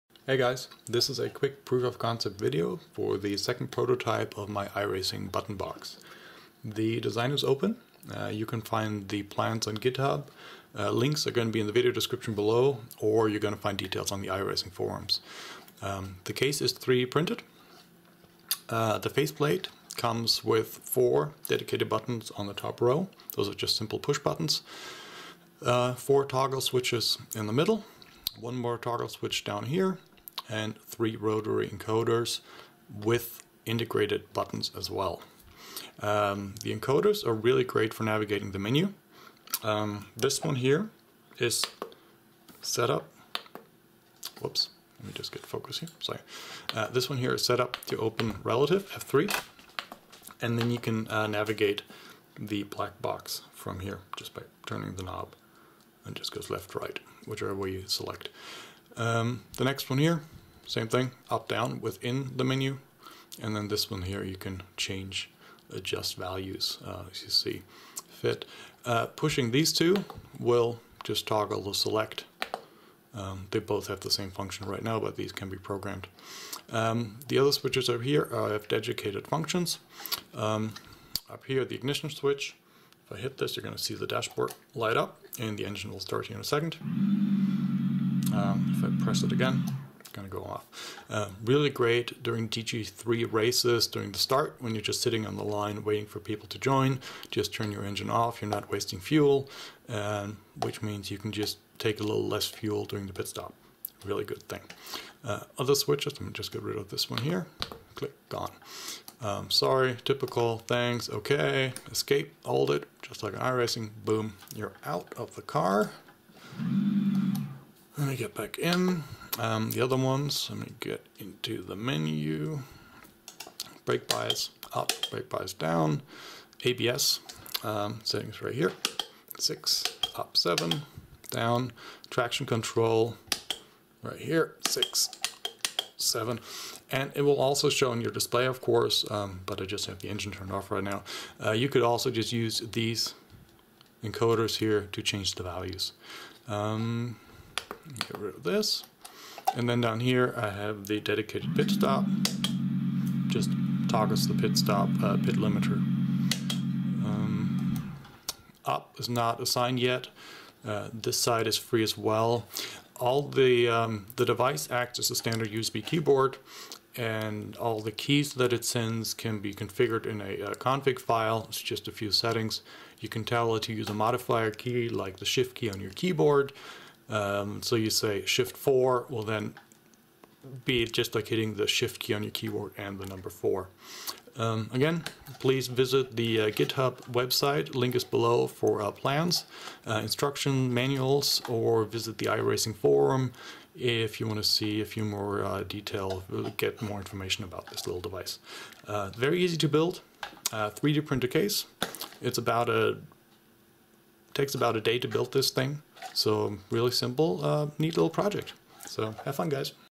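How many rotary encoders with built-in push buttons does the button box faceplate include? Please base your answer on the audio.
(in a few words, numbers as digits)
3.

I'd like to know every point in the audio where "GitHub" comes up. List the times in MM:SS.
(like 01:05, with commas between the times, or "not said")
00:09, 03:06.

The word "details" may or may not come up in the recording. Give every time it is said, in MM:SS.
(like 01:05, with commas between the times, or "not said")
00:13, 03:15.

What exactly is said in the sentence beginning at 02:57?
Um, so you say shift four will then be just like hitting the shift key on your keyboard and the number four.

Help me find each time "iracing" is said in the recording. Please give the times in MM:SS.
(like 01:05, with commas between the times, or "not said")
00:04, 00:14, 01:53, 03:12.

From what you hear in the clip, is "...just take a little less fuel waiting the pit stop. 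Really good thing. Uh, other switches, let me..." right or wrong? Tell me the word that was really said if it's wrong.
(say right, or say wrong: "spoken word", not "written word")
wrong: "during", not "waiting".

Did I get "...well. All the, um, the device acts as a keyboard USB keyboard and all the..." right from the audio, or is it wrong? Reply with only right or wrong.
wrong.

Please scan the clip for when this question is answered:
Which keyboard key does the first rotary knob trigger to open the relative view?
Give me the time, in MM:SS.
00:48.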